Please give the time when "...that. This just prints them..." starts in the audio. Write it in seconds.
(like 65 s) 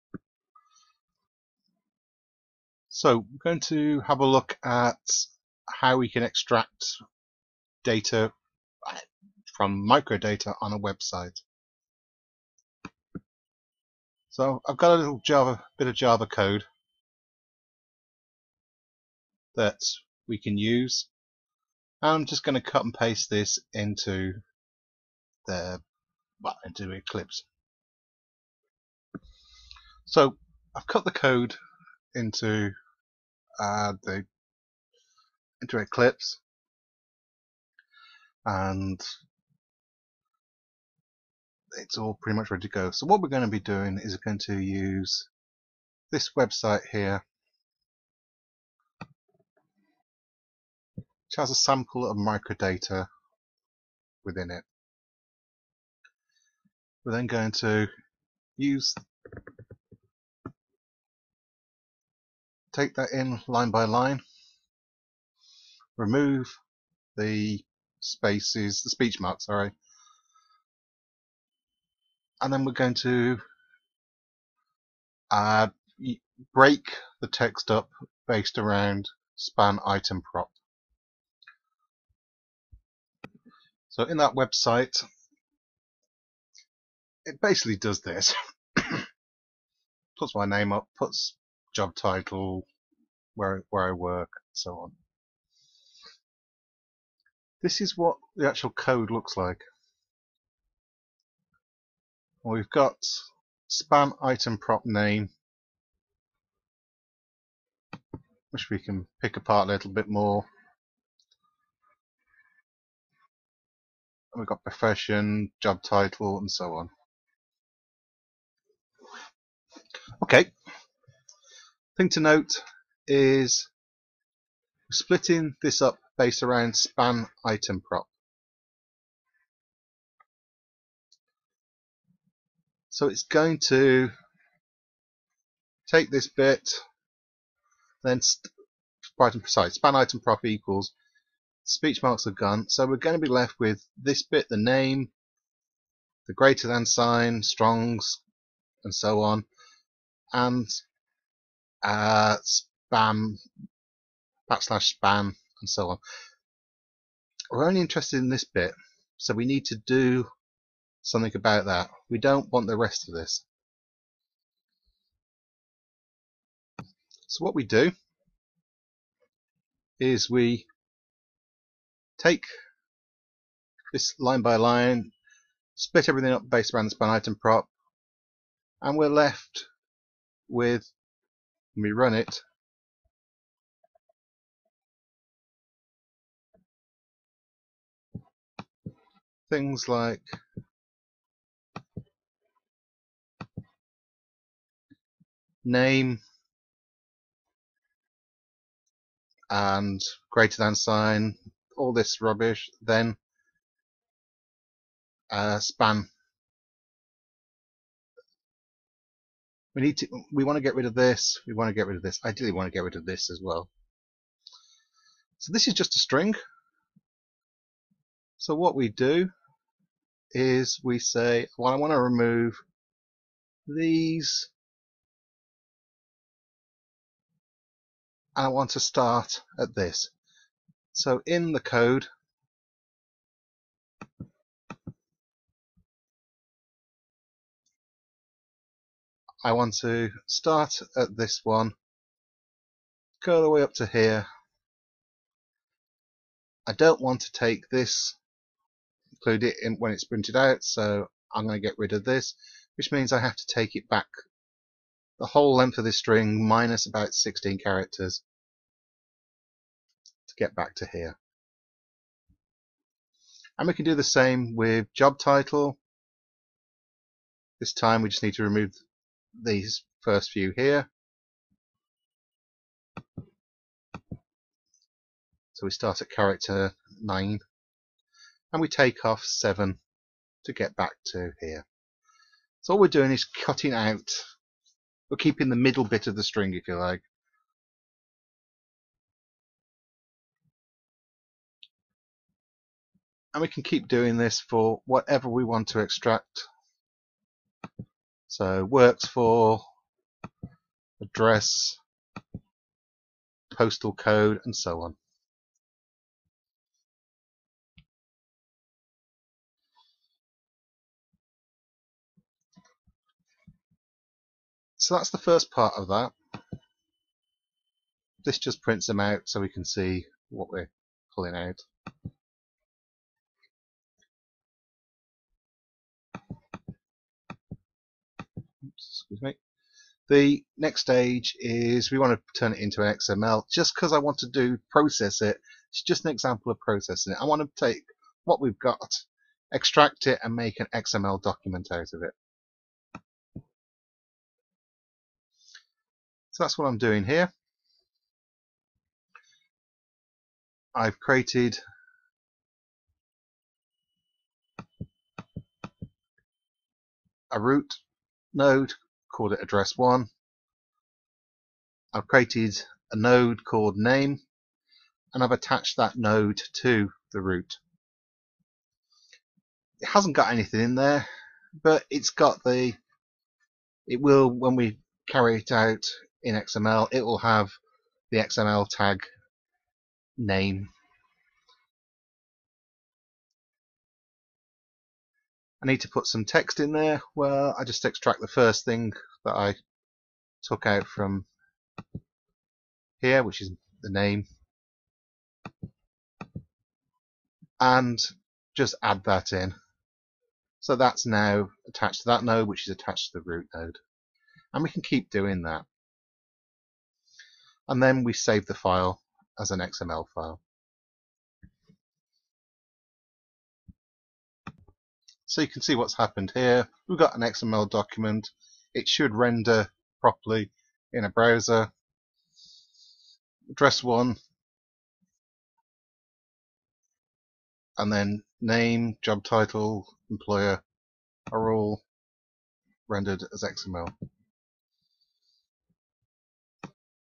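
315 s.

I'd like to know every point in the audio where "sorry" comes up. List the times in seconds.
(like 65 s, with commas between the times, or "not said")
69 s.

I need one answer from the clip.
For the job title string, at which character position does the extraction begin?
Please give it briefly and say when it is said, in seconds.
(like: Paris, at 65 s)
9, at 276 s.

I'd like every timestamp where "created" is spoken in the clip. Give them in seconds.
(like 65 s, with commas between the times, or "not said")
350 s, 362 s.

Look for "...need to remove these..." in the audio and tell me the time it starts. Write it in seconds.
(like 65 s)
268 s.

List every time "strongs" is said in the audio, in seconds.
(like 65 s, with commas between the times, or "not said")
147 s.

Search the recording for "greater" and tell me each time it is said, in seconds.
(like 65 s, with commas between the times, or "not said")
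146 s, 200 s.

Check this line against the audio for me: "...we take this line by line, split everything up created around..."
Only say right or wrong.
wrong.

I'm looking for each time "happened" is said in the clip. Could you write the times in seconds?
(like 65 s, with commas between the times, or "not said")
415 s.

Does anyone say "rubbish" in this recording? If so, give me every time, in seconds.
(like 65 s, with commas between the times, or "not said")
202 s.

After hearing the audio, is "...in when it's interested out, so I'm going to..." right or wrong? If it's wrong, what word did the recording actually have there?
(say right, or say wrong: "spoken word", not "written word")
wrong: "printed", not "interested".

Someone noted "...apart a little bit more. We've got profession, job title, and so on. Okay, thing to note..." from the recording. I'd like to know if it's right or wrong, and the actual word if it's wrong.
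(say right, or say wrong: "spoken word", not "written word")
right.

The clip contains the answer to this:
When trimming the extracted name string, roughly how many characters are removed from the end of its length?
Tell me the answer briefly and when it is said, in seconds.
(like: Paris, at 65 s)
16, at 257 s.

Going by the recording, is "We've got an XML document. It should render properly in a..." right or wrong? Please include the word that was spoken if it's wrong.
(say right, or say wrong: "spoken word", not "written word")
right.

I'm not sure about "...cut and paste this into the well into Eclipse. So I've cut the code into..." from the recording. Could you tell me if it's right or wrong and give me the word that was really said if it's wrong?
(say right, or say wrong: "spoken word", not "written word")
right.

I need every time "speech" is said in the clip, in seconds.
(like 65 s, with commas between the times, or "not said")
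68 s, 141 s.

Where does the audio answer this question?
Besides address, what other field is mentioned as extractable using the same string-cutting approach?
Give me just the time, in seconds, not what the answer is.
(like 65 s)
303 s.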